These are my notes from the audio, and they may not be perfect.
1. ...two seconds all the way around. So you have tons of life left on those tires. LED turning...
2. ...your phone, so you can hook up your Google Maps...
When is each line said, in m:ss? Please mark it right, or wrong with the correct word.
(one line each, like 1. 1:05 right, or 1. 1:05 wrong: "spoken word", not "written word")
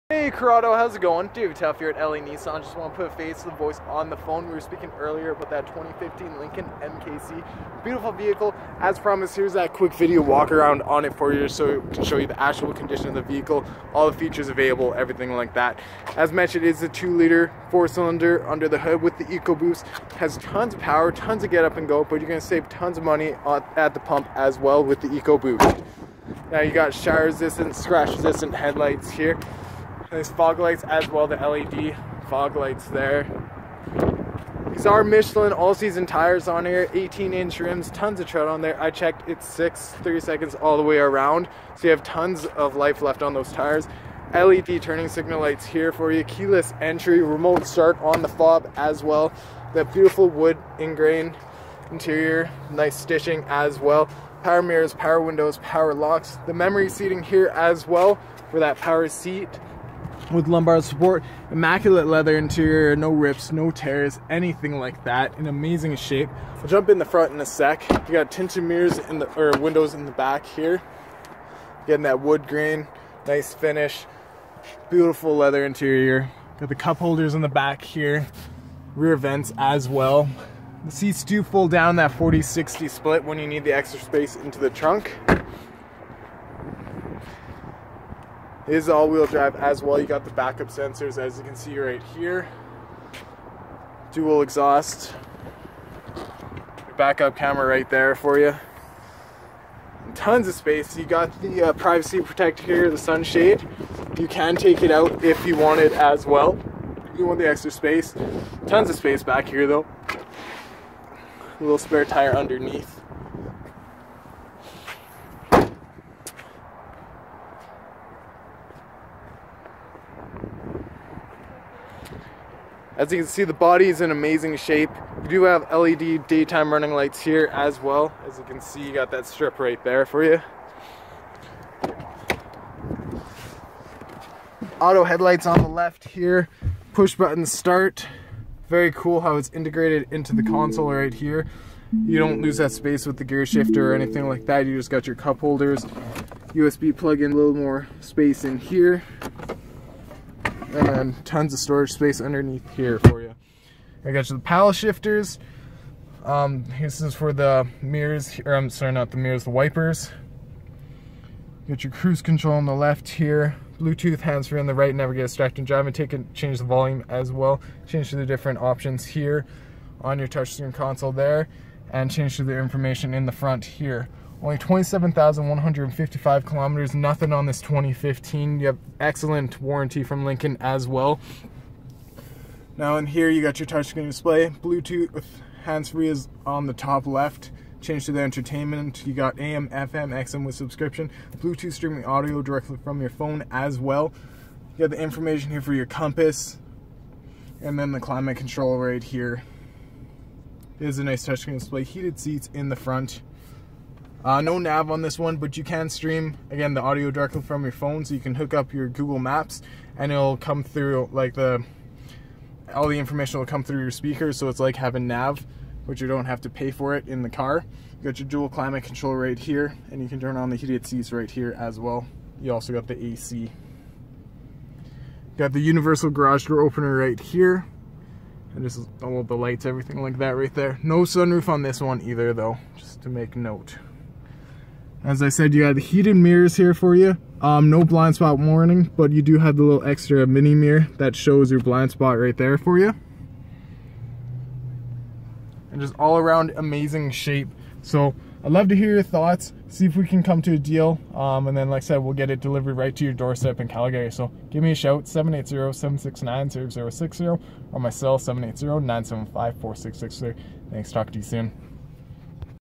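1. 0:40 wrong: "three", not "two"
2. 3:27 right.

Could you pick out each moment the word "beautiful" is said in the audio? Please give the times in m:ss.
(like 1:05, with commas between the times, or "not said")
0:07, 0:49, 1:14.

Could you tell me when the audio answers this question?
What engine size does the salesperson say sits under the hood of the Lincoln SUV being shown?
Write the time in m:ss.
0:16.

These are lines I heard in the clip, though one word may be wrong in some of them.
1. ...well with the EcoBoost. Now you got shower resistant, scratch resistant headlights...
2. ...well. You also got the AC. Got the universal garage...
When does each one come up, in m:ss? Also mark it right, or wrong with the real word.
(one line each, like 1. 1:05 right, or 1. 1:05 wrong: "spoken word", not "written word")
1. 0:24 right
2. 3:41 right.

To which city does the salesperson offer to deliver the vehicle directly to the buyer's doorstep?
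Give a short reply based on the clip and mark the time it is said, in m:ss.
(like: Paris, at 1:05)
Calgary, at 4:13.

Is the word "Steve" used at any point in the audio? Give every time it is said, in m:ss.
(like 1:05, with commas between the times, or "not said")
not said.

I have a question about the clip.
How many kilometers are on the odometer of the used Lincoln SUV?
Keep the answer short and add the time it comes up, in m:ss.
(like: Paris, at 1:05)
27,155, at 2:54.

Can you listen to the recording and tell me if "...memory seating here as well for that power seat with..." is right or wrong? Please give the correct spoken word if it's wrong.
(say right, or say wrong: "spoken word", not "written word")
right.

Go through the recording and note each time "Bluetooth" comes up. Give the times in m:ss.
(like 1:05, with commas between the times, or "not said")
2:43, 3:04, 3:11.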